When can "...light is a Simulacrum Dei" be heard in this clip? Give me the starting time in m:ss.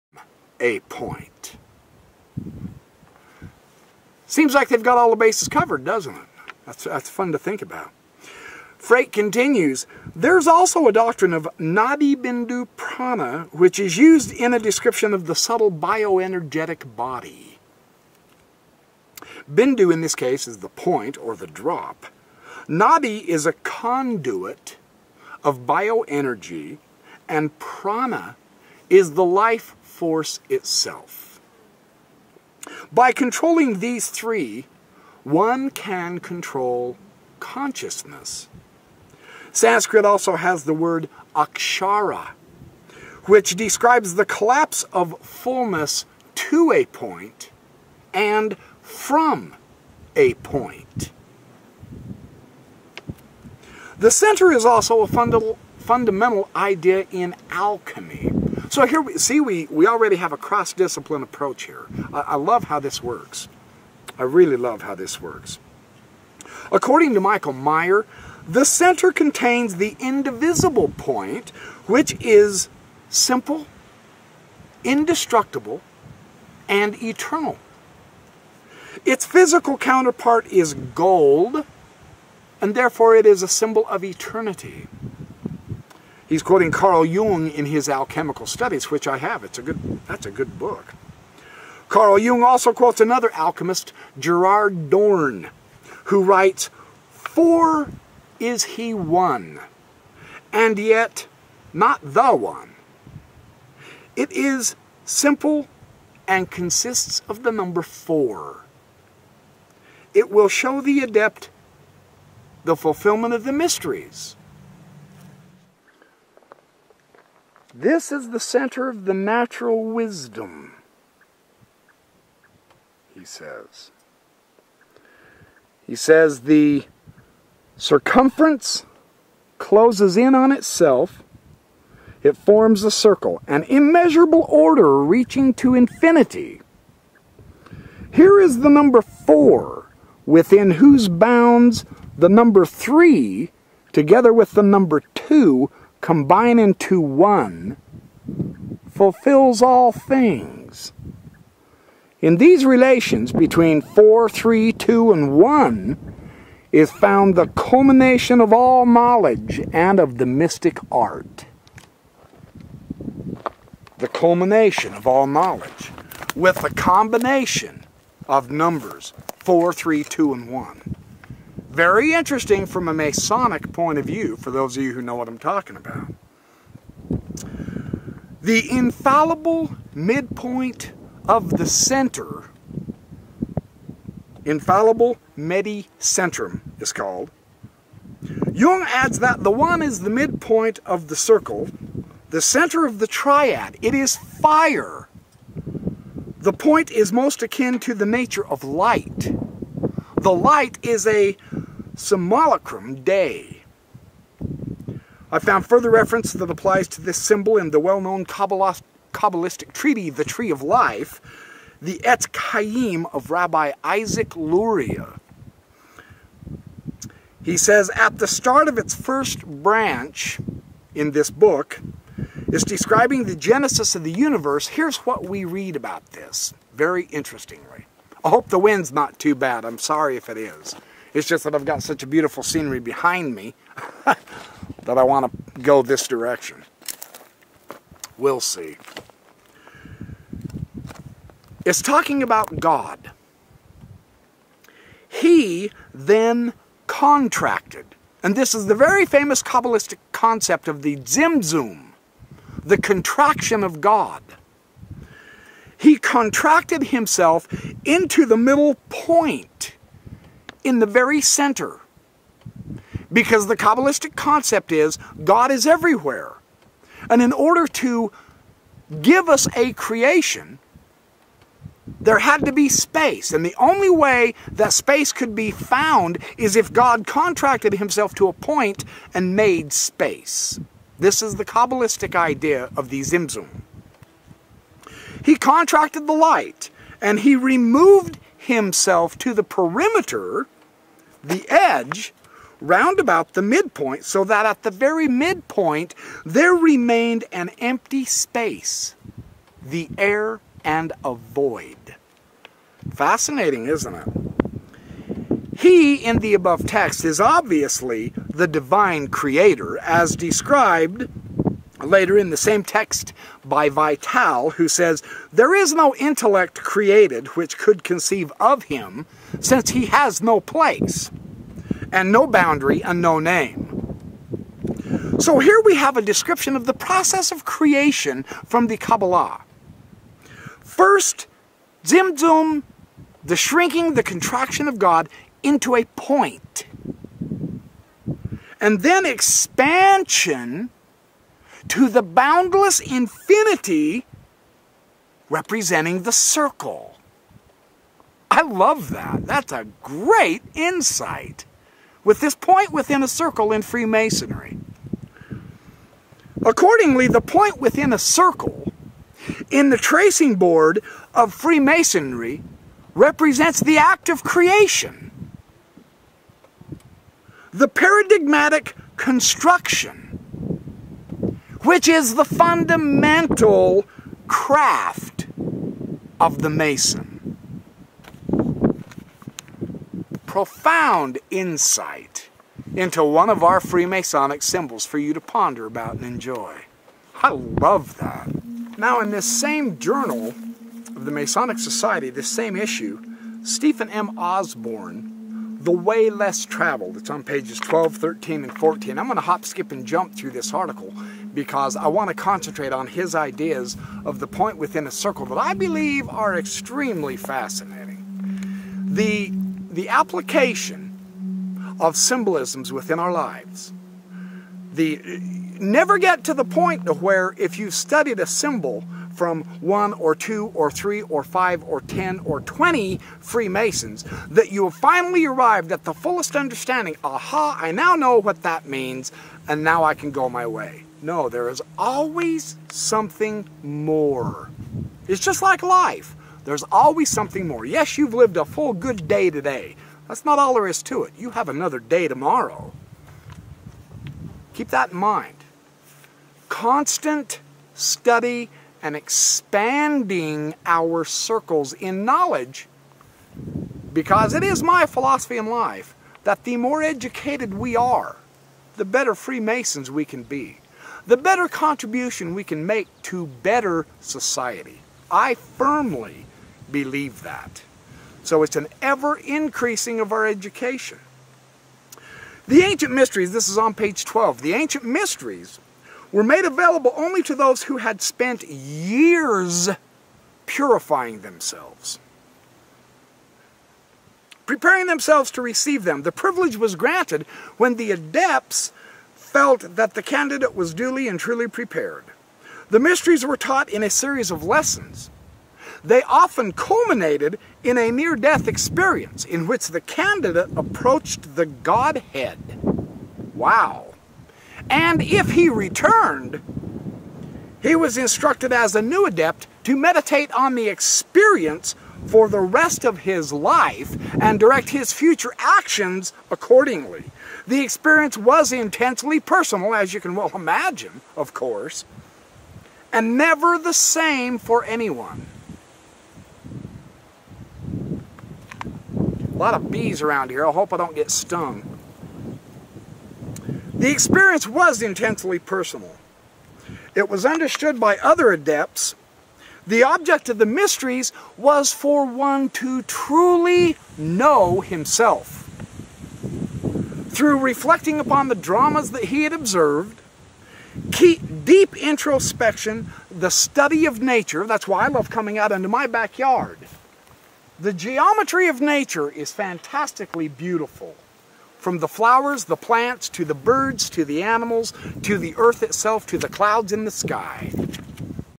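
3:20.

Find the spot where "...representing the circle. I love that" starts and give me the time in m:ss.
5:45.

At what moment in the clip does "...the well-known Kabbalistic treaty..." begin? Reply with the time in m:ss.
3:27.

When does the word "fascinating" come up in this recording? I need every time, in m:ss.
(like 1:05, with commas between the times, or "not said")
5:02, 6:47.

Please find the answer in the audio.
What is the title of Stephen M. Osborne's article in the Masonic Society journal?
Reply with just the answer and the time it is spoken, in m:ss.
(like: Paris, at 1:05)
The Way Less Traveled, at 6:35.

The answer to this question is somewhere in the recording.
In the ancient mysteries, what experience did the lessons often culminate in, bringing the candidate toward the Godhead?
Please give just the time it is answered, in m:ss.
8:17.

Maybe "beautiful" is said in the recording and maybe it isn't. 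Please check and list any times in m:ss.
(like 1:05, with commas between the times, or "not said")
3:52, 9:20.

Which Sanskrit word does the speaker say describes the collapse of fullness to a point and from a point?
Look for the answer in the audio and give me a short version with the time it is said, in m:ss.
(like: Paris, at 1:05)
akshara, at 0:41.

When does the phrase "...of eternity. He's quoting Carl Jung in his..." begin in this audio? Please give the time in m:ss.
1:23.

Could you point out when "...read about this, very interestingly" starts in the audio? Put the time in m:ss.
3:45.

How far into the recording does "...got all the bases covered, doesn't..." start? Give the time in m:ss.
0:04.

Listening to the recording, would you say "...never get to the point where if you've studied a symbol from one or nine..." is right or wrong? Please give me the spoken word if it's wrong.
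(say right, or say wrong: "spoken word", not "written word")
wrong: "two", not "nine".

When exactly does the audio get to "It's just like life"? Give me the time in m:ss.
7:15.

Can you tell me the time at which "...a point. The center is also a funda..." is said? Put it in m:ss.
0:50.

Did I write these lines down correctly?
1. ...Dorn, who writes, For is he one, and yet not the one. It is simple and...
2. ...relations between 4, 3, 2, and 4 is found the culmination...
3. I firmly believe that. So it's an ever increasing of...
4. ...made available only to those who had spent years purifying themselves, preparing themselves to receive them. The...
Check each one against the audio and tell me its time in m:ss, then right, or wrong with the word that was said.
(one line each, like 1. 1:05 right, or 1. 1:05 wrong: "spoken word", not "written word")
1. 1:34 right
2. 2:32 wrong: "1", not "4"
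3. 7:45 right
4. 7:56 right.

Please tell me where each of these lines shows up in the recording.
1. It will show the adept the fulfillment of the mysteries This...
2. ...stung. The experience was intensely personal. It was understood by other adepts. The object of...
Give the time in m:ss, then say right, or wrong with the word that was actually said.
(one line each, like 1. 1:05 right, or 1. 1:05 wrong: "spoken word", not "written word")
1. 1:50 right
2. 8:51 right.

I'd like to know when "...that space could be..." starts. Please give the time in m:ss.
4:34.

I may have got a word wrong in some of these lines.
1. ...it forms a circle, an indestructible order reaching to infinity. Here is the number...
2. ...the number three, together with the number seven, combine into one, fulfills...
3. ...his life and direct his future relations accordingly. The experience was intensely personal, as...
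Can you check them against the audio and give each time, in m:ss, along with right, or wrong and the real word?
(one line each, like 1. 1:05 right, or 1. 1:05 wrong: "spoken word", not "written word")
1. 2:12 wrong: "immeasurable", not "indestructible"
2. 2:22 wrong: "two", not "seven"
3. 8:32 wrong: "actions", not "relations".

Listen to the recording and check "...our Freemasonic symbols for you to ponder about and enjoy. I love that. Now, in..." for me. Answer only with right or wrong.
right.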